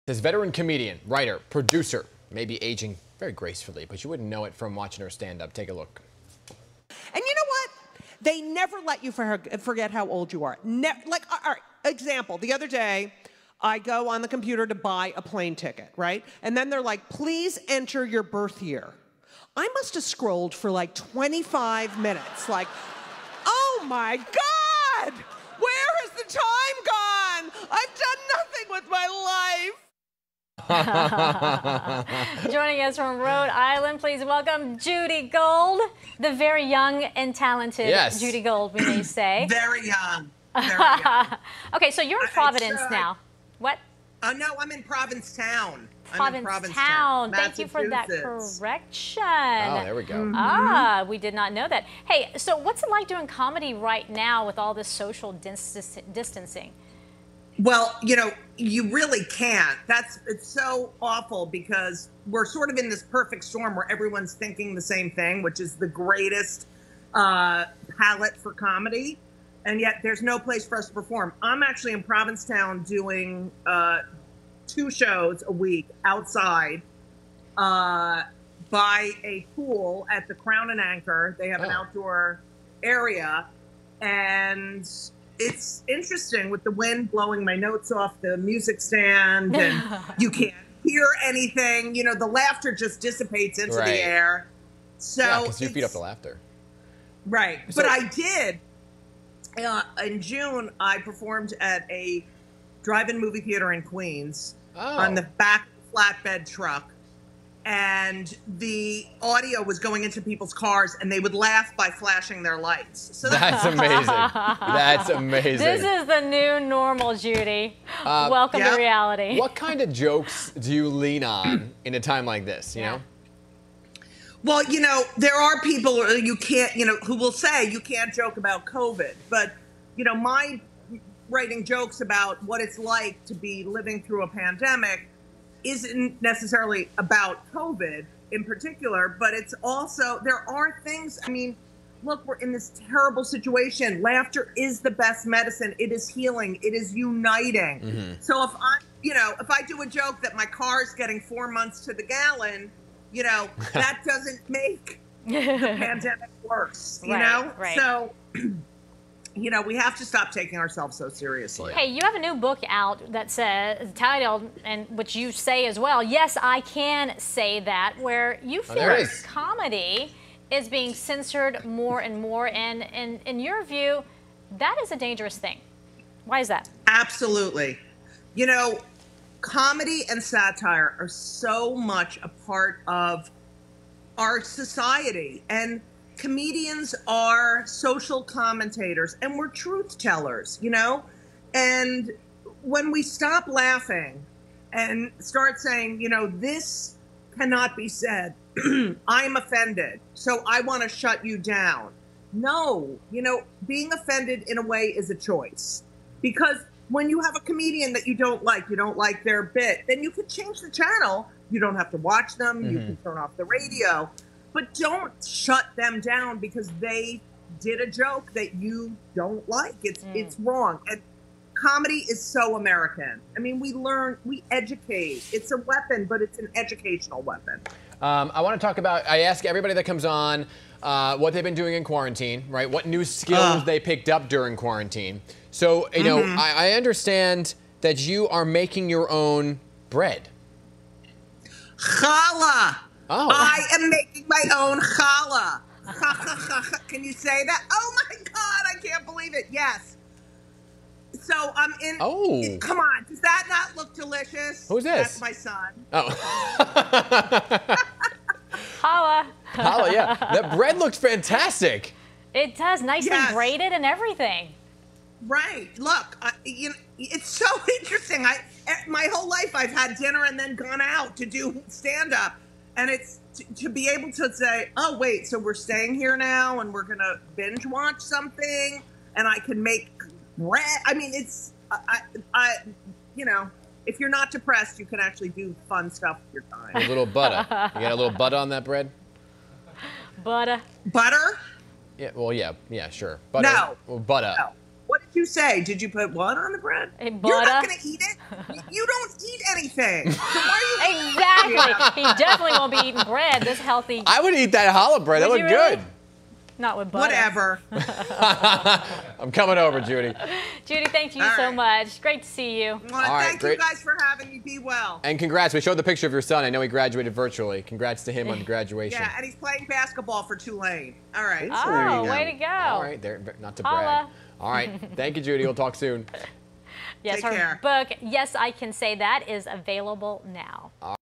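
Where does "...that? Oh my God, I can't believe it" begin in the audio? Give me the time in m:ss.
4:07.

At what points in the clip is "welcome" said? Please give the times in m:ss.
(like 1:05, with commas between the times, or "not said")
0:34, 1:58.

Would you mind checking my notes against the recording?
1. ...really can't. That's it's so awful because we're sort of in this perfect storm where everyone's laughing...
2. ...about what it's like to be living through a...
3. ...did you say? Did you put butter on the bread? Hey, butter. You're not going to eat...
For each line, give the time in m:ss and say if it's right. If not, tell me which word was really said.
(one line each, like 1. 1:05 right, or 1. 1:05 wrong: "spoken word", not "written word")
1. 0:58 wrong: "thinking", not "laughing"
2. 2:12 right
3. 4:55 right.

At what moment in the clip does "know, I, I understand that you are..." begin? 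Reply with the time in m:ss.
3:56.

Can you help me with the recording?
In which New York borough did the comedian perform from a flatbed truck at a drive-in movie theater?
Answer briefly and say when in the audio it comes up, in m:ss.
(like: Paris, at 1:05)
Queens, at 1:43.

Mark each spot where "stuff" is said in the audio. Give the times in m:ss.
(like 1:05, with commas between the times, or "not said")
4:45.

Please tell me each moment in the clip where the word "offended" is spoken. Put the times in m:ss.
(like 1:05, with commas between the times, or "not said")
3:19, 3:23.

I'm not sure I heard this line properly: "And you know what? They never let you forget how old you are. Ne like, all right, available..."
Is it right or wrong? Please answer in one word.
wrong.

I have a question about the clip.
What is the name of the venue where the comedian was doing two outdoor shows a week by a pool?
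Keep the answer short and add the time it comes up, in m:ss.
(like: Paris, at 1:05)
Crown and Anchor, at 1:20.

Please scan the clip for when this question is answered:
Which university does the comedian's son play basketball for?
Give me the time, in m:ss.
5:20.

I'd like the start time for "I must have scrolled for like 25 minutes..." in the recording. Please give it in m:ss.
0:19.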